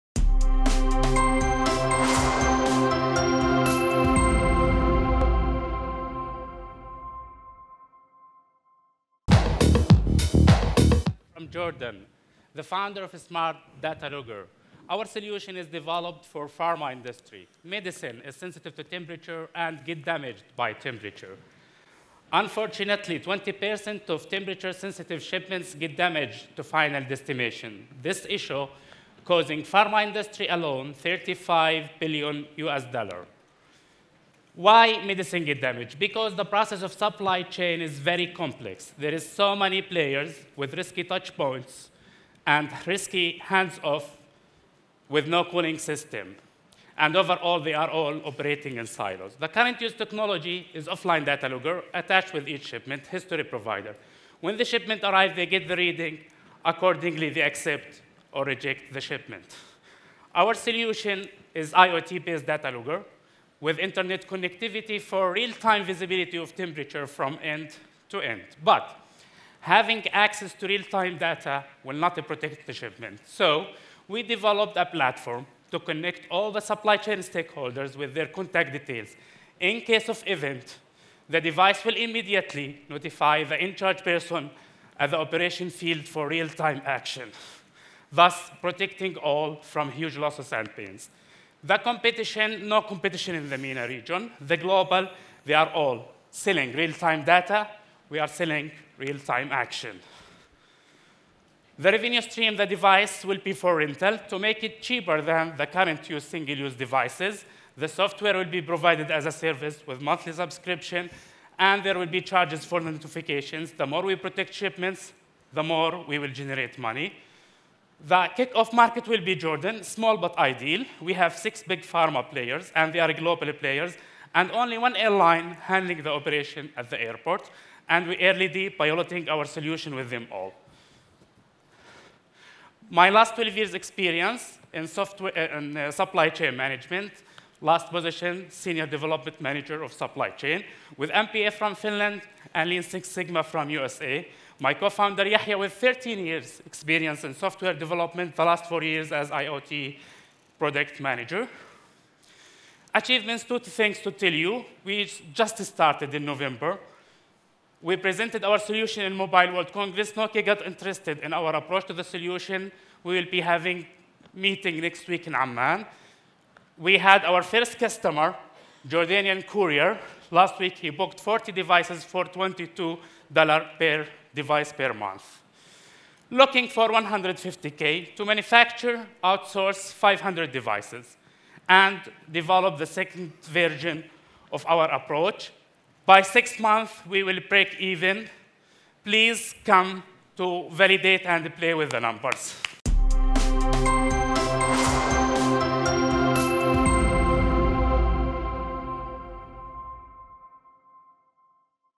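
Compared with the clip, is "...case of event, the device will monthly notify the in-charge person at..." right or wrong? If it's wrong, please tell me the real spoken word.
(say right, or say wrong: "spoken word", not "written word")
wrong: "immediately", not "monthly".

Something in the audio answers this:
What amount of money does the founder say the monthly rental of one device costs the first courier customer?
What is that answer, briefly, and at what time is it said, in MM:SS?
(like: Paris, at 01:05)
$22, at 02:52.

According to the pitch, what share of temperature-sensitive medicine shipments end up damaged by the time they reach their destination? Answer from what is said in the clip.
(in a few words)
20%.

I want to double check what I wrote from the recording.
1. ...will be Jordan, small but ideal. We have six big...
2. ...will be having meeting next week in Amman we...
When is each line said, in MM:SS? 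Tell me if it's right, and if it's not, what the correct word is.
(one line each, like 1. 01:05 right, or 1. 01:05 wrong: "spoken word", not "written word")
1. 01:59 right
2. 02:43 right.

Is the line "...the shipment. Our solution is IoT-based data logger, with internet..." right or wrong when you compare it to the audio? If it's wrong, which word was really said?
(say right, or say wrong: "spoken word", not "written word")
right.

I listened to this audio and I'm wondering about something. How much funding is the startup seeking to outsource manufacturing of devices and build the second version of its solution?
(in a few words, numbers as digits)
150K.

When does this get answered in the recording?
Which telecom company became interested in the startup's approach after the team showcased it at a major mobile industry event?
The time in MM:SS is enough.
02:40.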